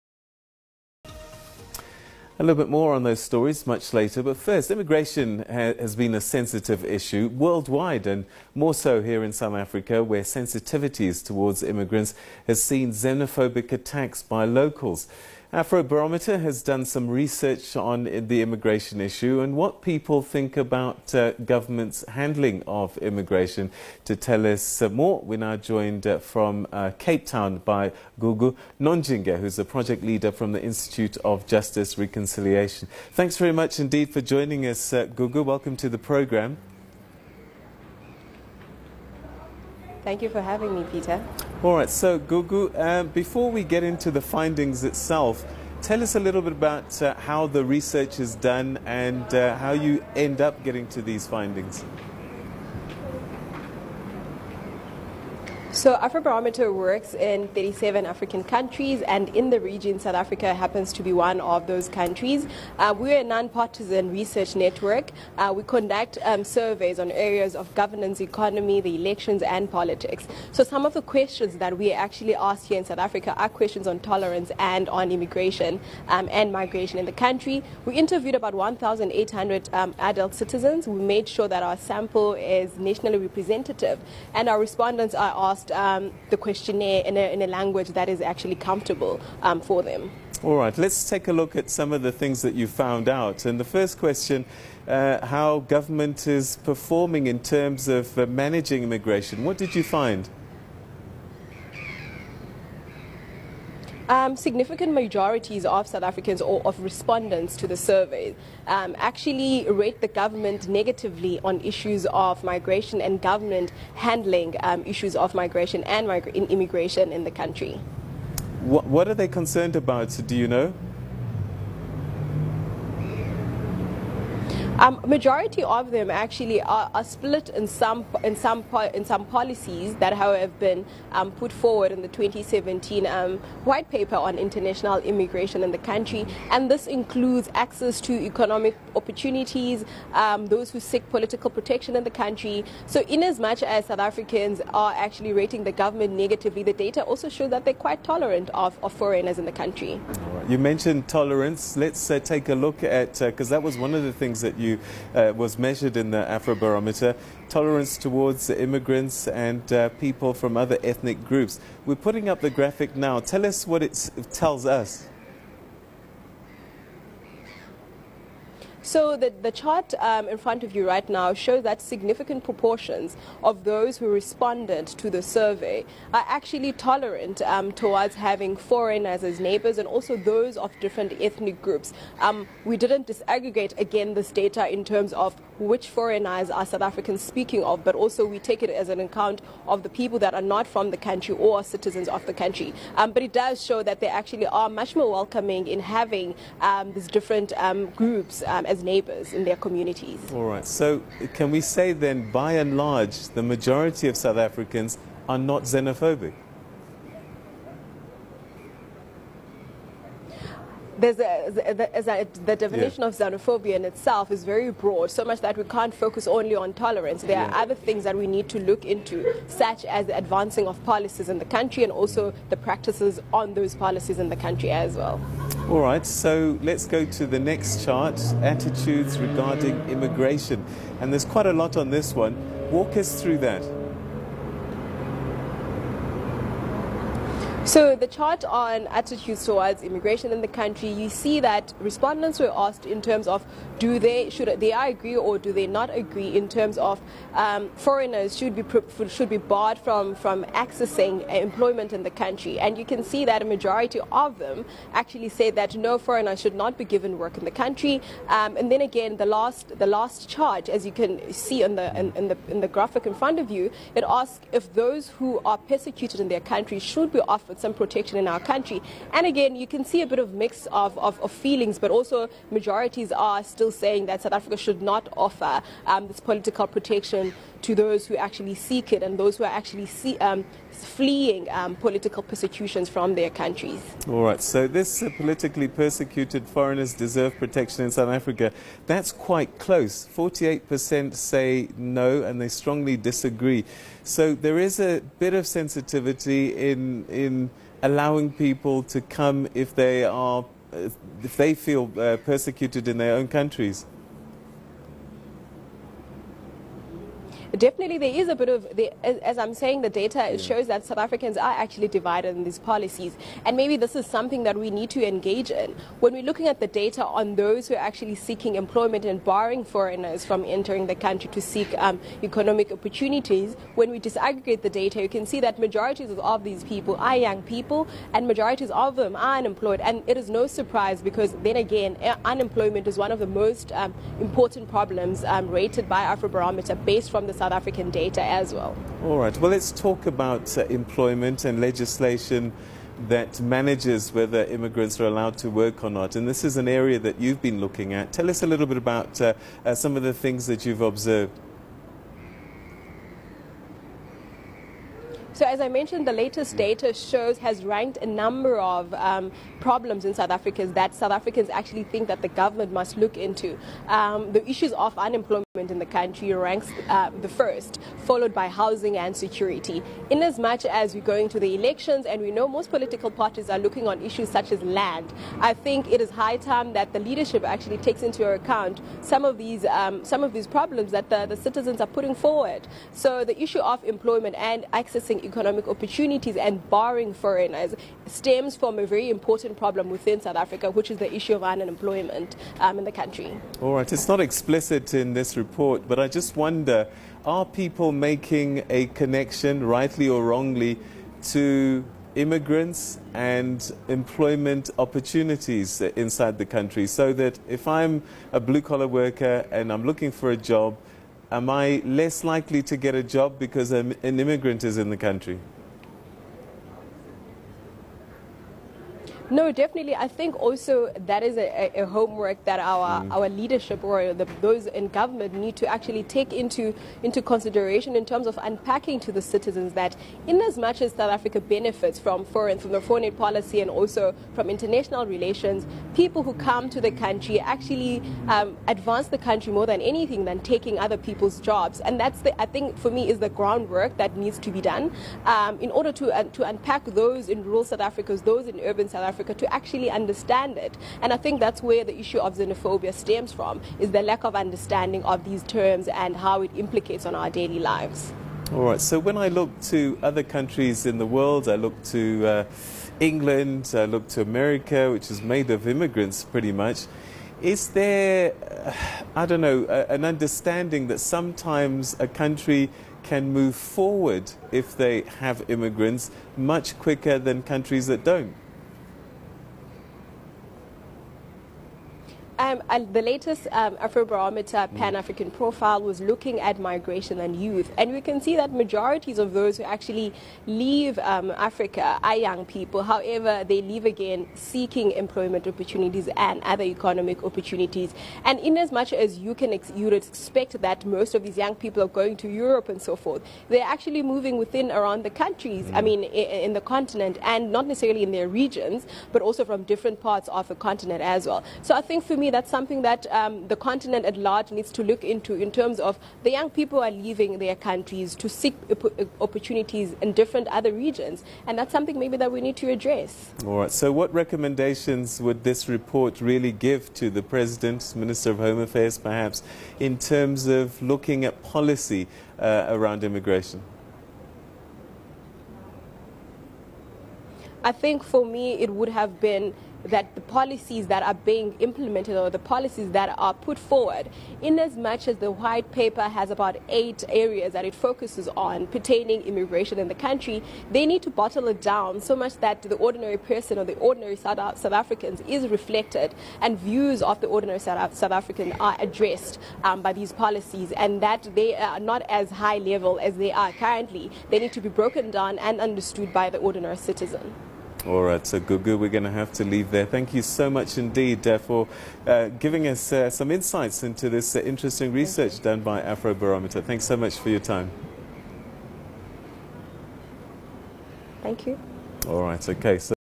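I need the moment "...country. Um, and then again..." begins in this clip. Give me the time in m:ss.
4:17.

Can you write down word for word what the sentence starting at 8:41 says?
And that's something maybe that we need to address.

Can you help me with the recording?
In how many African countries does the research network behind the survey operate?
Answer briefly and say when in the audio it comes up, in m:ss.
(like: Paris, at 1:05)
37, at 0:57.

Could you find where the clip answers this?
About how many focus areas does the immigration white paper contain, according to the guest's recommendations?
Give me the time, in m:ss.
9:06.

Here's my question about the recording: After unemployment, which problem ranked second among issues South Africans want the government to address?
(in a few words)
Housing.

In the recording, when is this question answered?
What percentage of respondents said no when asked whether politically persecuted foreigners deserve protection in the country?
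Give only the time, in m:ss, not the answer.
4:50.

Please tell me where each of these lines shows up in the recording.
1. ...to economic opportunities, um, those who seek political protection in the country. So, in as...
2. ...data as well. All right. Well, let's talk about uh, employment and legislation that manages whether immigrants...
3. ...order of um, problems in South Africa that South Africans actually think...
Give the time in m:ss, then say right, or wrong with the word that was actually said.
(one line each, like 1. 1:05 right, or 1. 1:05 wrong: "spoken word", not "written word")
1. 2:18 right
2. 5:37 right
3. 5:58 wrong: "number", not "order".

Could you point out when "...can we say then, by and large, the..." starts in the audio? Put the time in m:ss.
3:21.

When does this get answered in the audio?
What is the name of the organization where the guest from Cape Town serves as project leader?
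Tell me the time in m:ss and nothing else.
0:30.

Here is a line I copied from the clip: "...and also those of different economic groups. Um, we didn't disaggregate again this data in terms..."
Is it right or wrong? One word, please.
wrong.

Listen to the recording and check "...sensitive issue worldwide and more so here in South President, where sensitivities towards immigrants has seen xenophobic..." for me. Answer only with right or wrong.
wrong.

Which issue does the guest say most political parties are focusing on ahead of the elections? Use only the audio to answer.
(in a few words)
Land.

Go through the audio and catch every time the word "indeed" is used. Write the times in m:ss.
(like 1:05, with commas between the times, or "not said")
0:33, 9:30.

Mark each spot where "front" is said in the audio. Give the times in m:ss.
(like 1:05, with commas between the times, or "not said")
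2:50, 4:23.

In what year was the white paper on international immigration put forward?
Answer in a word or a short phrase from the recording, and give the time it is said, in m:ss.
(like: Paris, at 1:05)
2017, at 2:12.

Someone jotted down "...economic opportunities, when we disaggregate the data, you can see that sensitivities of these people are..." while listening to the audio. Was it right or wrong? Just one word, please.
wrong.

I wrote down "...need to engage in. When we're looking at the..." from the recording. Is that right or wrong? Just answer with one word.
right.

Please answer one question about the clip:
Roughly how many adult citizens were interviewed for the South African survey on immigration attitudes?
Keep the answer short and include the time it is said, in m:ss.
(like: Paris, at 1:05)
1,800, at 1:18.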